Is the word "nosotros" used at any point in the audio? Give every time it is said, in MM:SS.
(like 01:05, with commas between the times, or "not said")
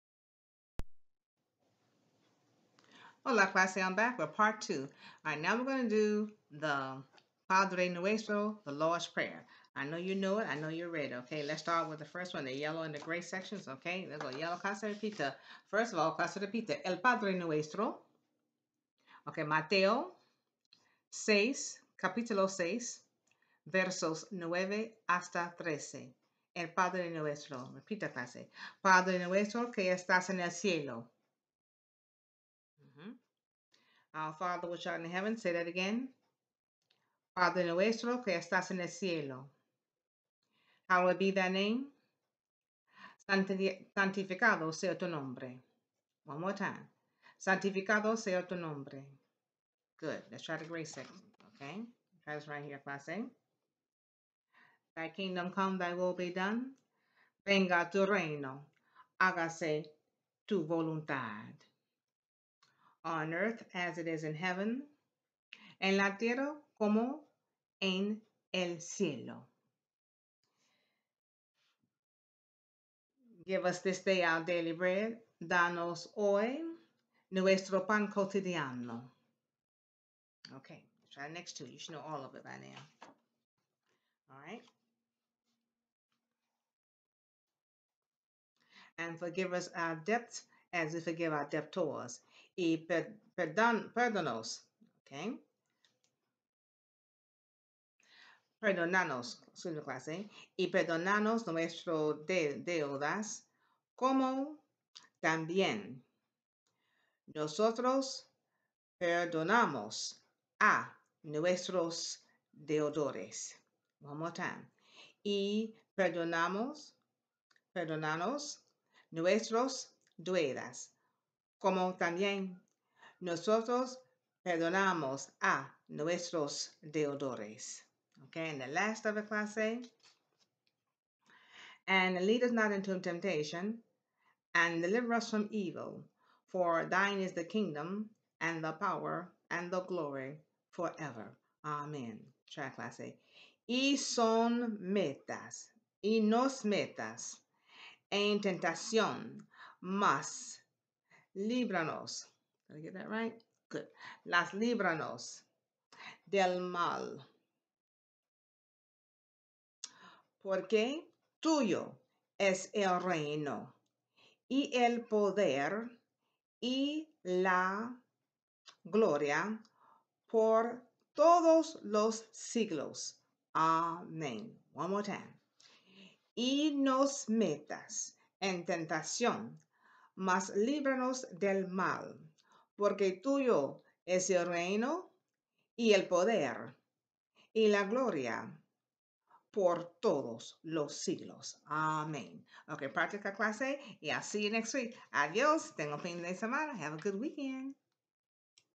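01:47, 02:03.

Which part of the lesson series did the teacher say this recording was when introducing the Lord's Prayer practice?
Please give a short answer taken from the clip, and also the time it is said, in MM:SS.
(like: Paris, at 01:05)
part two, at 00:04.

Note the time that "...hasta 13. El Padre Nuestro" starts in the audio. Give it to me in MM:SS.
00:25.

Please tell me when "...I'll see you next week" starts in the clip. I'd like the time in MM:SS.
03:14.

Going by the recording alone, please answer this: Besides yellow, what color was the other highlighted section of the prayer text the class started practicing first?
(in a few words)
gray.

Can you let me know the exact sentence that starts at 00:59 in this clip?
Hágase tu voluntad on earth as it is in heaven, en la tierra como en el cielo.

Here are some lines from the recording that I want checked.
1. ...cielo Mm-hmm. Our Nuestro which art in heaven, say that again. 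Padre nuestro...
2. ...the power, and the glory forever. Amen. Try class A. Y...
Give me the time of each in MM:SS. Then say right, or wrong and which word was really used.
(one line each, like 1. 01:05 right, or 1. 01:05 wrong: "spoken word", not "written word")
1. 00:30 wrong: "Father", not "Nuestro"
2. 02:18 right.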